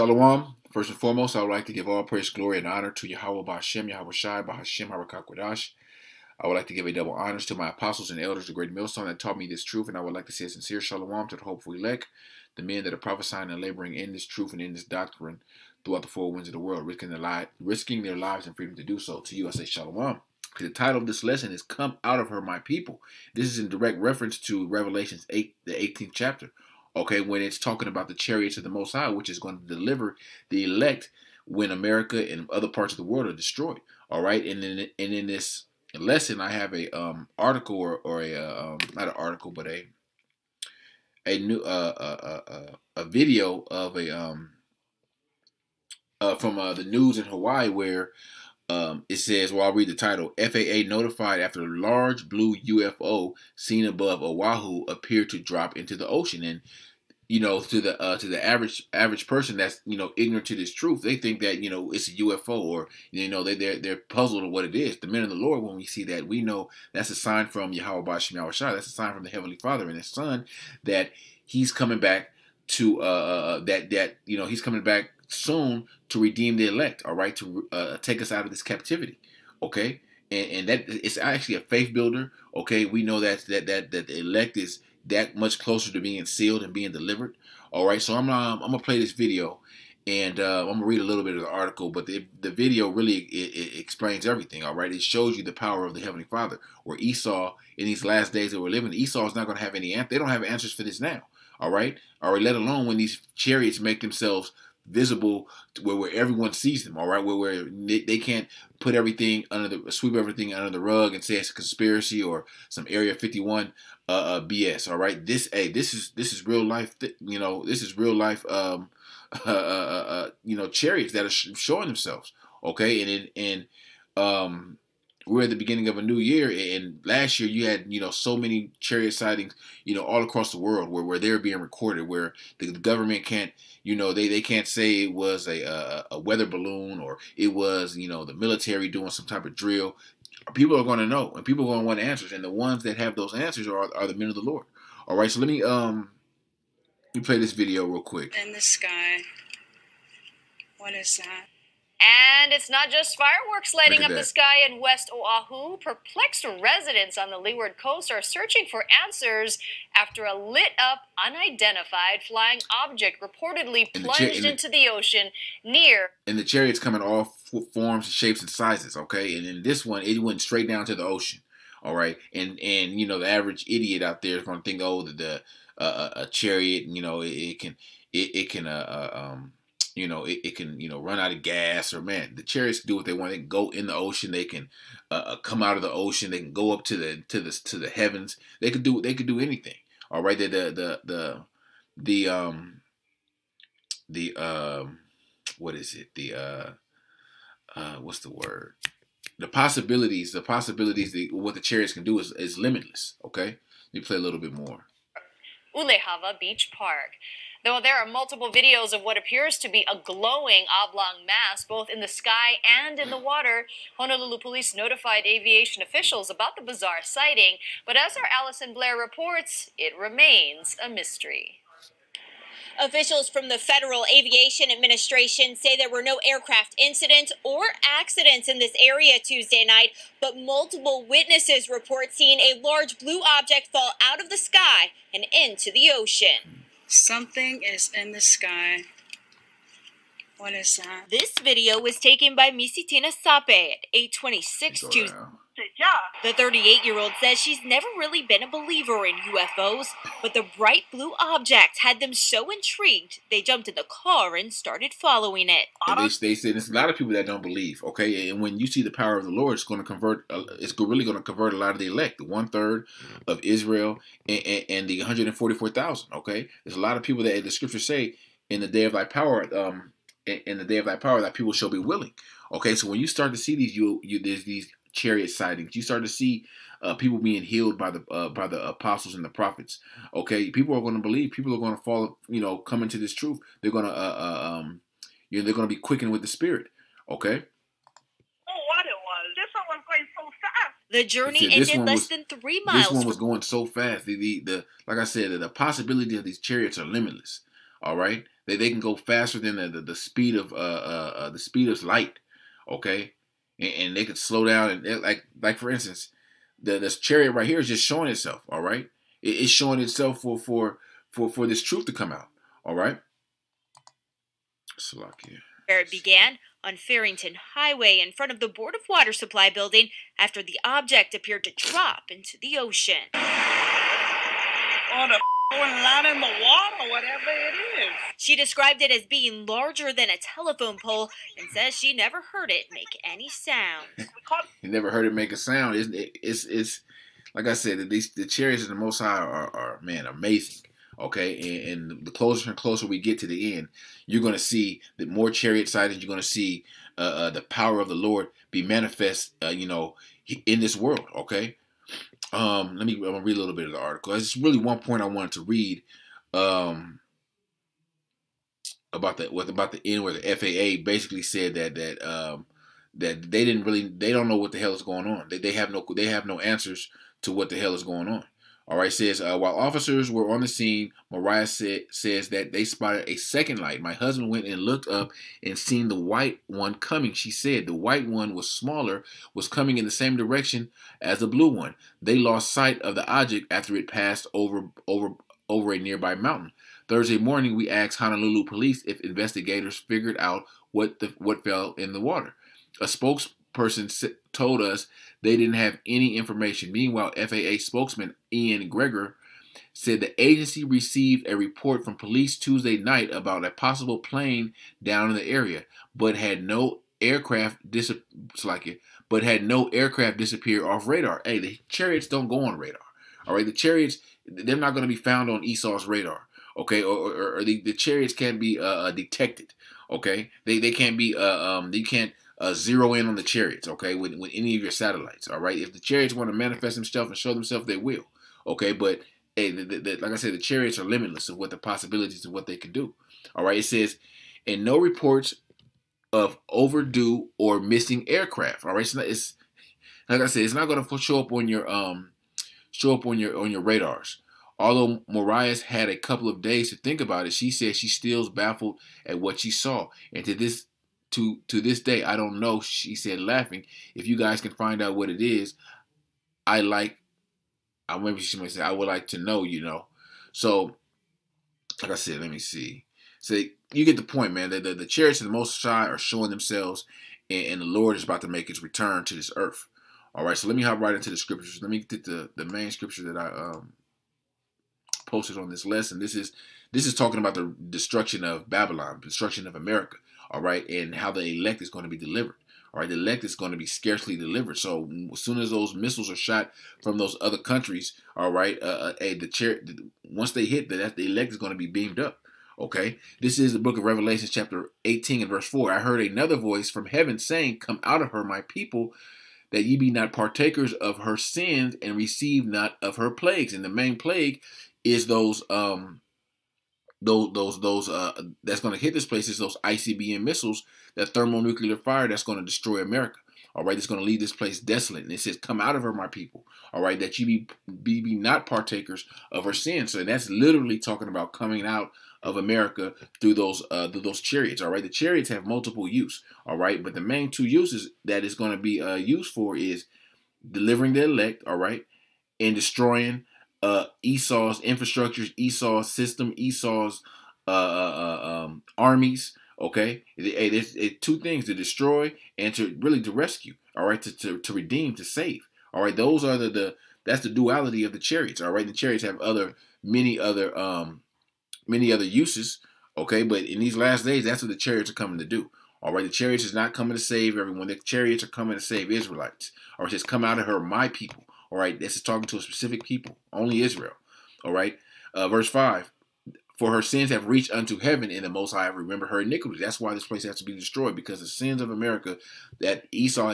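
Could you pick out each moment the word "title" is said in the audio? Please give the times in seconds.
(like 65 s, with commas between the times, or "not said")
20 s, 49 s.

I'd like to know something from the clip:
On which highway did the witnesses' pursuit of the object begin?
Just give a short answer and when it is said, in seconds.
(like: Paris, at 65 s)
Farrington Highway, at 316 s.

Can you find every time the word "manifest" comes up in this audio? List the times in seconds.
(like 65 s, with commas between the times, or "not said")
348 s, 426 s.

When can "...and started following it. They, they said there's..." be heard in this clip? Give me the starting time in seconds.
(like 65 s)
254 s.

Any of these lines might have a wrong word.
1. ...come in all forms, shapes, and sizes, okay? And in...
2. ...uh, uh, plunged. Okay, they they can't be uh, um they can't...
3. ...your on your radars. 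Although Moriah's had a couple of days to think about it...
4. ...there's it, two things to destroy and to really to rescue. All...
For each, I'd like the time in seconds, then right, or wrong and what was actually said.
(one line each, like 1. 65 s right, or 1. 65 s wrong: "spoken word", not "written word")
1. 166 s right
2. 418 s wrong: "detected", not "plunged"
3. 443 s right
4. 540 s right.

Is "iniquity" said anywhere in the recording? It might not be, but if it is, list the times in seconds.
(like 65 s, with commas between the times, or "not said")
569 s.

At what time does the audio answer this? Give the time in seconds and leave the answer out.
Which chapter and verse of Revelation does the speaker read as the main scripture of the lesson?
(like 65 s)
494 s.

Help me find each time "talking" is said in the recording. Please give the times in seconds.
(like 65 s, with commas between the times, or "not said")
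27 s, 476 s, 520 s, 562 s.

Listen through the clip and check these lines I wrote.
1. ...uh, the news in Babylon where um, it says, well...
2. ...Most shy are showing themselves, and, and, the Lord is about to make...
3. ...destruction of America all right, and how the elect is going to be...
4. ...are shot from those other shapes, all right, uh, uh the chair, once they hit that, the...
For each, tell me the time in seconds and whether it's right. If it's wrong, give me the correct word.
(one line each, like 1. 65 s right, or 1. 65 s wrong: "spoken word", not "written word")
1. 46 s wrong: "Hawaii", not "Babylon"
2. 465 s right
3. 479 s right
4. 486 s wrong: "countries", not "shapes".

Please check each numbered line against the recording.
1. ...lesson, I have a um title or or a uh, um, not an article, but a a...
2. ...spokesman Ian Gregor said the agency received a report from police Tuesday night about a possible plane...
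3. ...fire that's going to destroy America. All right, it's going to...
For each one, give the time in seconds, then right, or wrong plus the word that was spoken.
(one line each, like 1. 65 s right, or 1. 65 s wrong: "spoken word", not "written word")
1. 35 s wrong: "article", not "title"
2. 397 s right
3. 511 s right.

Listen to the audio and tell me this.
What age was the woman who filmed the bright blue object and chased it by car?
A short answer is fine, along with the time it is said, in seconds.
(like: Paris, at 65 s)
38, at 246 s.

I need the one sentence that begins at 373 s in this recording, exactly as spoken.
My husband went and looked up and seen the white one coming.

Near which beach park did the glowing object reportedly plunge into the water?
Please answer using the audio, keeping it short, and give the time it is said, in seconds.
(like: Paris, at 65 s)
Ulehawa Beach Park, at 205 s.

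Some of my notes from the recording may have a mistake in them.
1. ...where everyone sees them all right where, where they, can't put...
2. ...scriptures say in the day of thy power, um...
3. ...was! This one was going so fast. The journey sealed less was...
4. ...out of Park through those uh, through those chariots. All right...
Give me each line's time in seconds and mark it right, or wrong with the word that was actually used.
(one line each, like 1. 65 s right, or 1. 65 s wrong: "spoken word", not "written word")
1. 105 s right
2. 267 s right
3. 289 s wrong: "ended", not "sealed"
4. 521 s wrong: "America", not "Park".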